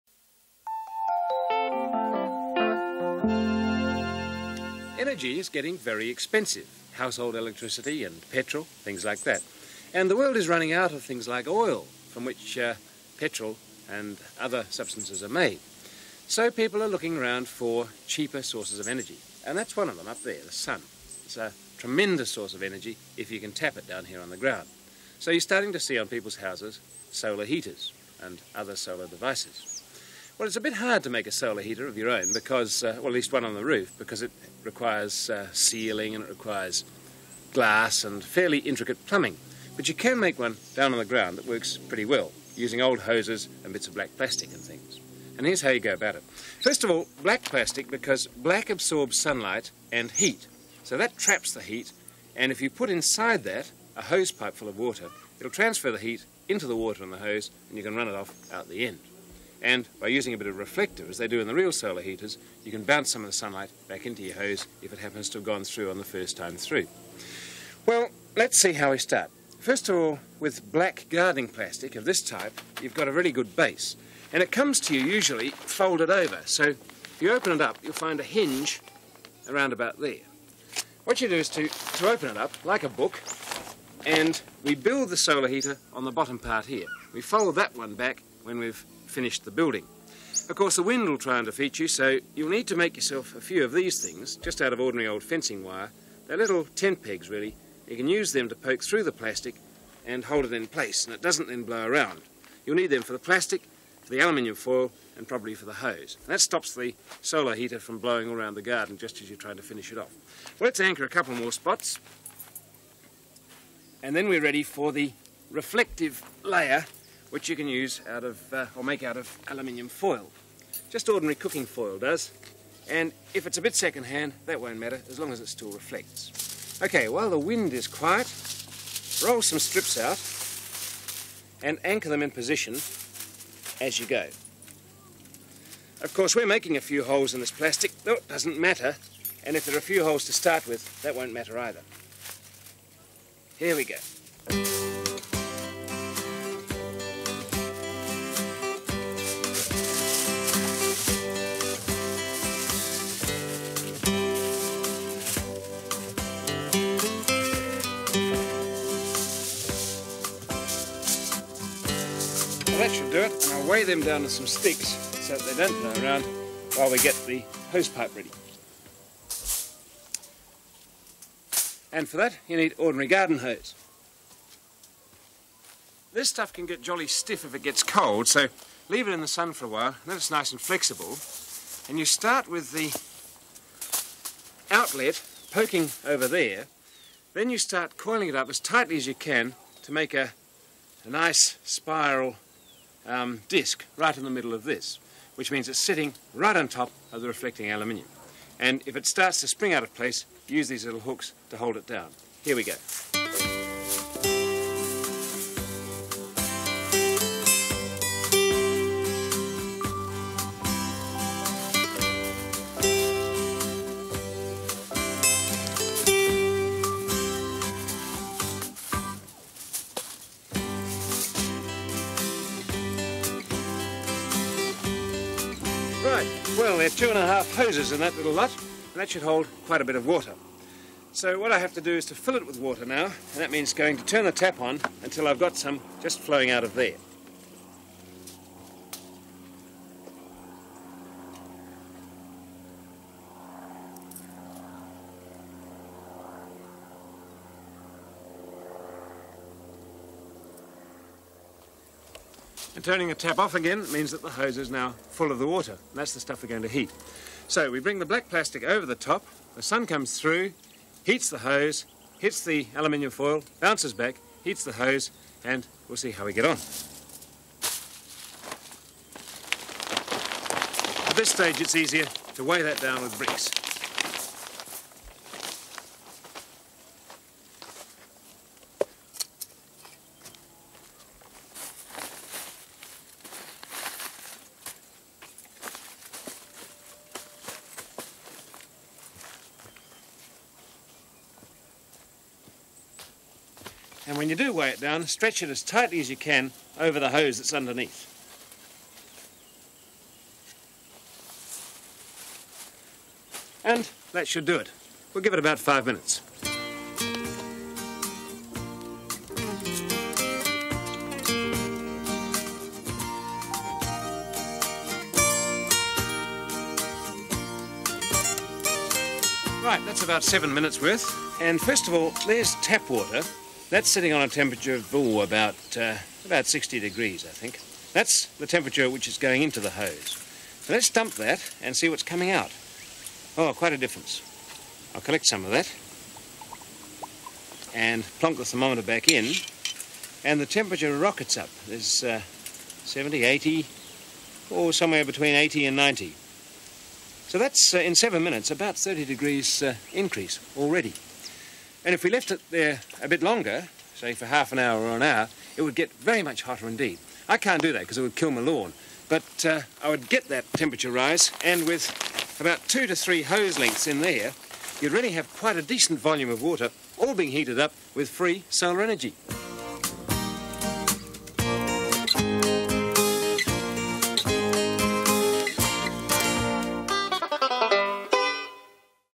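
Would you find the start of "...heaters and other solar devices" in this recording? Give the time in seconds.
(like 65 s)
27 s.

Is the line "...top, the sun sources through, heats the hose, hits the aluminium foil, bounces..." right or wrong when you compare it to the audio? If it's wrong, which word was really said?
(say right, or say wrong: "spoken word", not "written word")
wrong: "comes", not "sources".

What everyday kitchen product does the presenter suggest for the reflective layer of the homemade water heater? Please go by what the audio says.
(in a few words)
cooking foil.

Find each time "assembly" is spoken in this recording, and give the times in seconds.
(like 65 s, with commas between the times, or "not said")
not said.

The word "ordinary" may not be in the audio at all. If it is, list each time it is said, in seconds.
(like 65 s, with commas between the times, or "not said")
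94 s, 121 s, 172 s.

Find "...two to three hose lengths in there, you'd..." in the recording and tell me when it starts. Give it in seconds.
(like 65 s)
362 s.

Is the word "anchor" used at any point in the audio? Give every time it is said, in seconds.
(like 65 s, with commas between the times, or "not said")
110 s, 131 s.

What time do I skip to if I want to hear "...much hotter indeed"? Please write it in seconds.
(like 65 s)
356 s.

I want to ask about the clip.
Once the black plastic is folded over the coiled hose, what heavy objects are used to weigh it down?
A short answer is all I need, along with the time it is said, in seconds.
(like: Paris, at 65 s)
bricks, at 273 s.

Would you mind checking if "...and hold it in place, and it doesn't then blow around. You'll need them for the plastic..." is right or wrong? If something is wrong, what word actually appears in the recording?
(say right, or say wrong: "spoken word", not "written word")
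right.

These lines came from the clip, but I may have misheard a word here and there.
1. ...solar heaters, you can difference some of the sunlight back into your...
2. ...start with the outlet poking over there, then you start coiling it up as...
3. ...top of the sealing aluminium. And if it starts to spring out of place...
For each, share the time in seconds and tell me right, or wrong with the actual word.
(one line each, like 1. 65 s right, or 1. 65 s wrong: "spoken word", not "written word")
1. 61 s wrong: "bounce", not "difference"
2. 182 s right
3. 196 s wrong: "reflecting", not "sealing".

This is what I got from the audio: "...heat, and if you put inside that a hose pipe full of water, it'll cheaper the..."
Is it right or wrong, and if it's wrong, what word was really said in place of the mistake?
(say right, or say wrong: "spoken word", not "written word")
wrong: "transfer", not "cheaper".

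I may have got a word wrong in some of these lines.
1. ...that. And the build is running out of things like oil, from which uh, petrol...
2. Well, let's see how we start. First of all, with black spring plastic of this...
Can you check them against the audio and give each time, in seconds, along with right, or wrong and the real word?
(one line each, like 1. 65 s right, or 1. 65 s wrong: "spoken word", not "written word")
1. 9 s wrong: "world", not "build"
2. 67 s wrong: "guarding", not "spring".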